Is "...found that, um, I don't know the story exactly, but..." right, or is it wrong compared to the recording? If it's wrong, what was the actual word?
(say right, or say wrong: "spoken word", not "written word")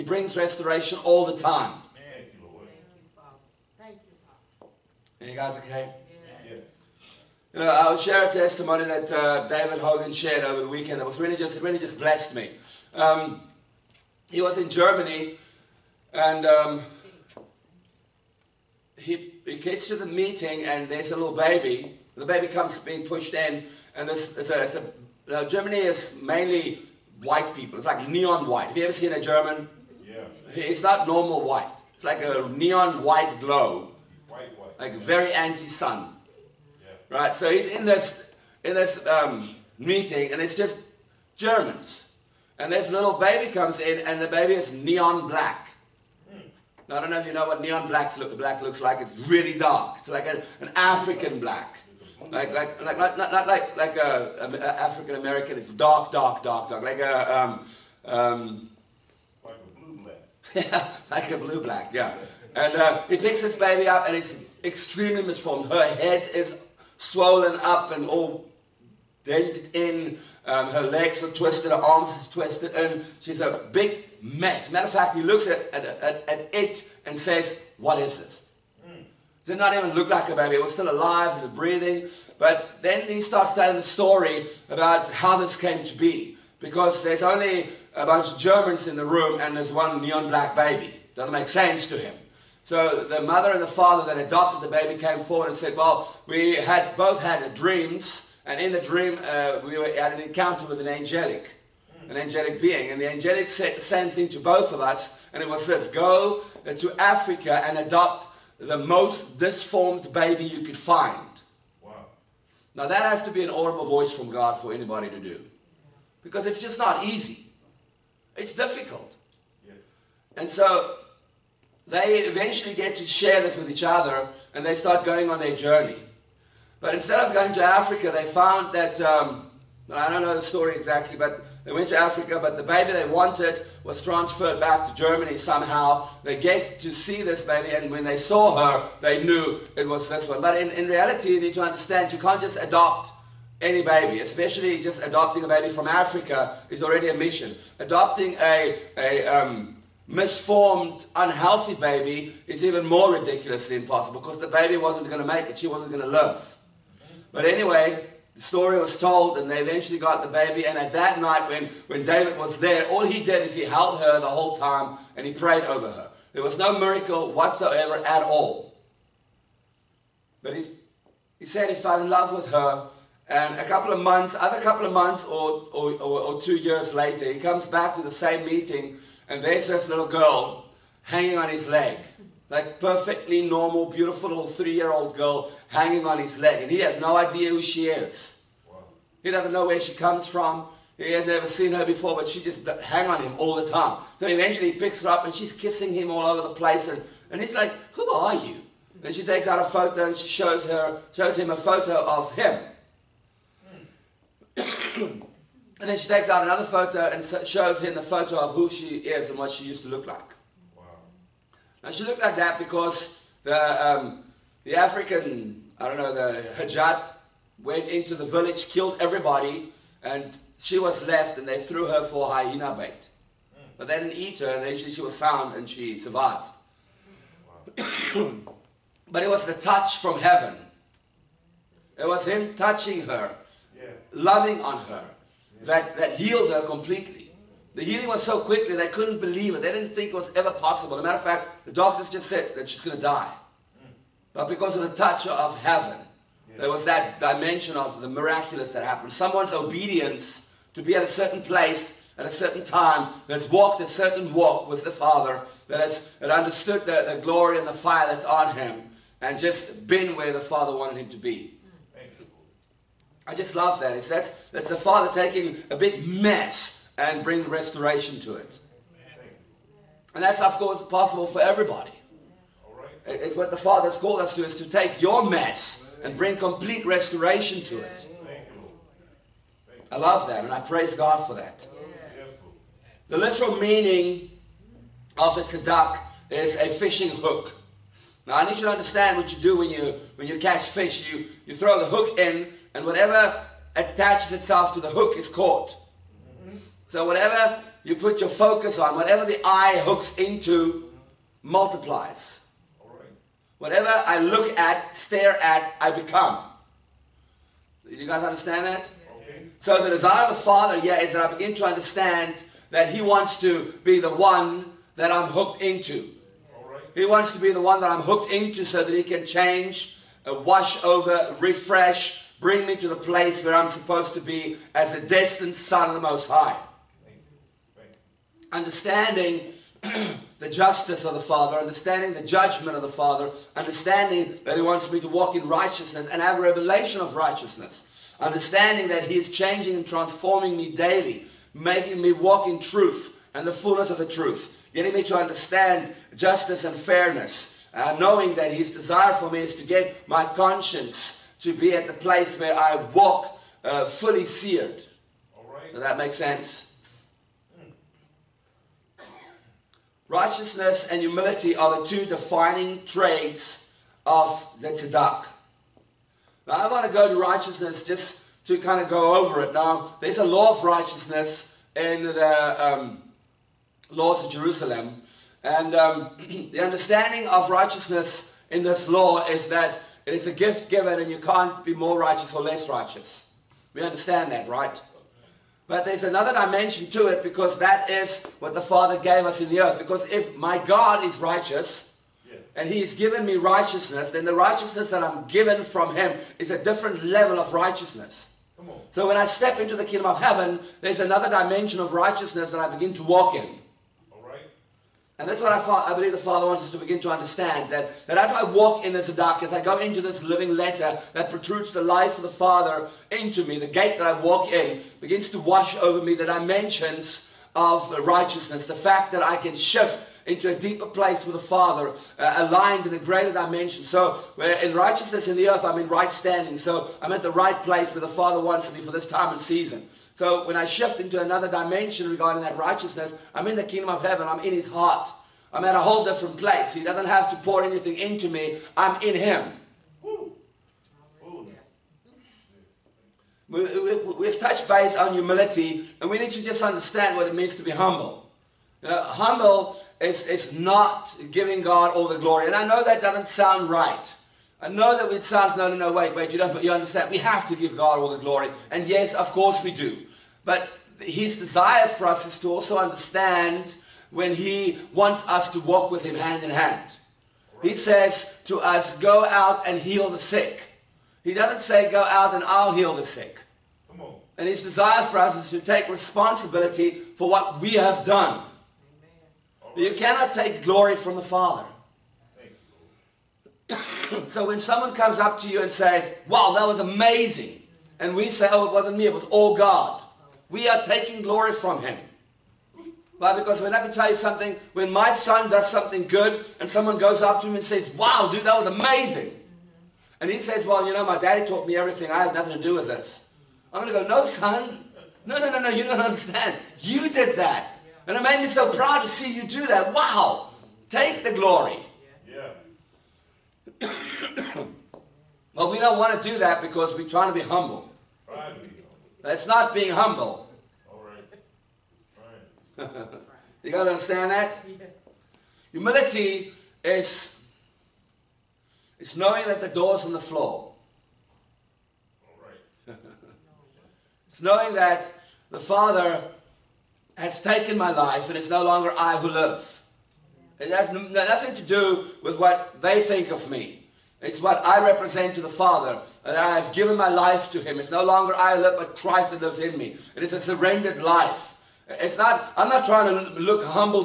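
right.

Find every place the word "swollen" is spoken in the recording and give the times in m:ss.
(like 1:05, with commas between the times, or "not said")
1:06.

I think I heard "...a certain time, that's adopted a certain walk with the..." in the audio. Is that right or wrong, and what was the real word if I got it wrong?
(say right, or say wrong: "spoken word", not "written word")
wrong: "walked", not "adopted".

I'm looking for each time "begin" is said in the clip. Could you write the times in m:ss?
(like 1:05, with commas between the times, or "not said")
5:11, 6:42, 6:46, 6:54.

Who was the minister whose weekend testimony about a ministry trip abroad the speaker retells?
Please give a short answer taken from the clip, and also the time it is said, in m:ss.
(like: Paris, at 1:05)
David Hogan, at 0:09.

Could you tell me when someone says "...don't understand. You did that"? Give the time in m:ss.
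8:25.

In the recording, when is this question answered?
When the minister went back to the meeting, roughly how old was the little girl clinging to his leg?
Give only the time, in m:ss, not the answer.
3:04.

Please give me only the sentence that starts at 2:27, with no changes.
Adopting a, a um, misformed, unhealthy baby is even more ridiculously impossible because the baby wasn't going to make it.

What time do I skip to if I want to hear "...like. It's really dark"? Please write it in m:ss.
0:48.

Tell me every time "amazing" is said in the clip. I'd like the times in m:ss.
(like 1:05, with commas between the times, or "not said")
8:06, 8:18.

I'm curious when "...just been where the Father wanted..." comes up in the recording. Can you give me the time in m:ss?
4:19.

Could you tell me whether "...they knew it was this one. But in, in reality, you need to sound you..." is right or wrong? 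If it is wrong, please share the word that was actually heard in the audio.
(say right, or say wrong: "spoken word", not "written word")
wrong: "understand", not "sound".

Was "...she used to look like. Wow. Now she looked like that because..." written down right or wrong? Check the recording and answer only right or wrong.
right.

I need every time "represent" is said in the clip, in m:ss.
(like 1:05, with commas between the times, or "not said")
9:04.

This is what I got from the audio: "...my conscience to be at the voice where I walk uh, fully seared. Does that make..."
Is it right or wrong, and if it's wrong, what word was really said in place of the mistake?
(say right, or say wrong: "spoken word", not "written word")
wrong: "place", not "voice".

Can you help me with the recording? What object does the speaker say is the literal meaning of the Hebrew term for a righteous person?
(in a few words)
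fishing hook.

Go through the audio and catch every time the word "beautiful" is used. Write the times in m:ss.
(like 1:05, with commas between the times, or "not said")
3:03.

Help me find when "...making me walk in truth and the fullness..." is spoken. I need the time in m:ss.
5:41.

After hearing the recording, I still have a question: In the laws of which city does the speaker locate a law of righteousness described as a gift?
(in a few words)
Jerusalem.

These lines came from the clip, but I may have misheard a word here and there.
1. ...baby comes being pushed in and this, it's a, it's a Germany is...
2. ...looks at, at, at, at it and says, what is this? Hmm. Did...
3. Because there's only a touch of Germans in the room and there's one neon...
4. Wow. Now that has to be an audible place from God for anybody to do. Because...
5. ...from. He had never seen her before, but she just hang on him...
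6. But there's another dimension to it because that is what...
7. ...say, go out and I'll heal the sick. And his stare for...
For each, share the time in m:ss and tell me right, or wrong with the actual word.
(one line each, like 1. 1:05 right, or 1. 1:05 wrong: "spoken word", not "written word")
1. 0:22 right
2. 1:15 right
3. 1:26 wrong: "bunch", not "touch"
4. 1:51 wrong: "voice", not "place"
5. 3:10 right
6. 6:25 right
7. 7:51 wrong: "desire", not "stare".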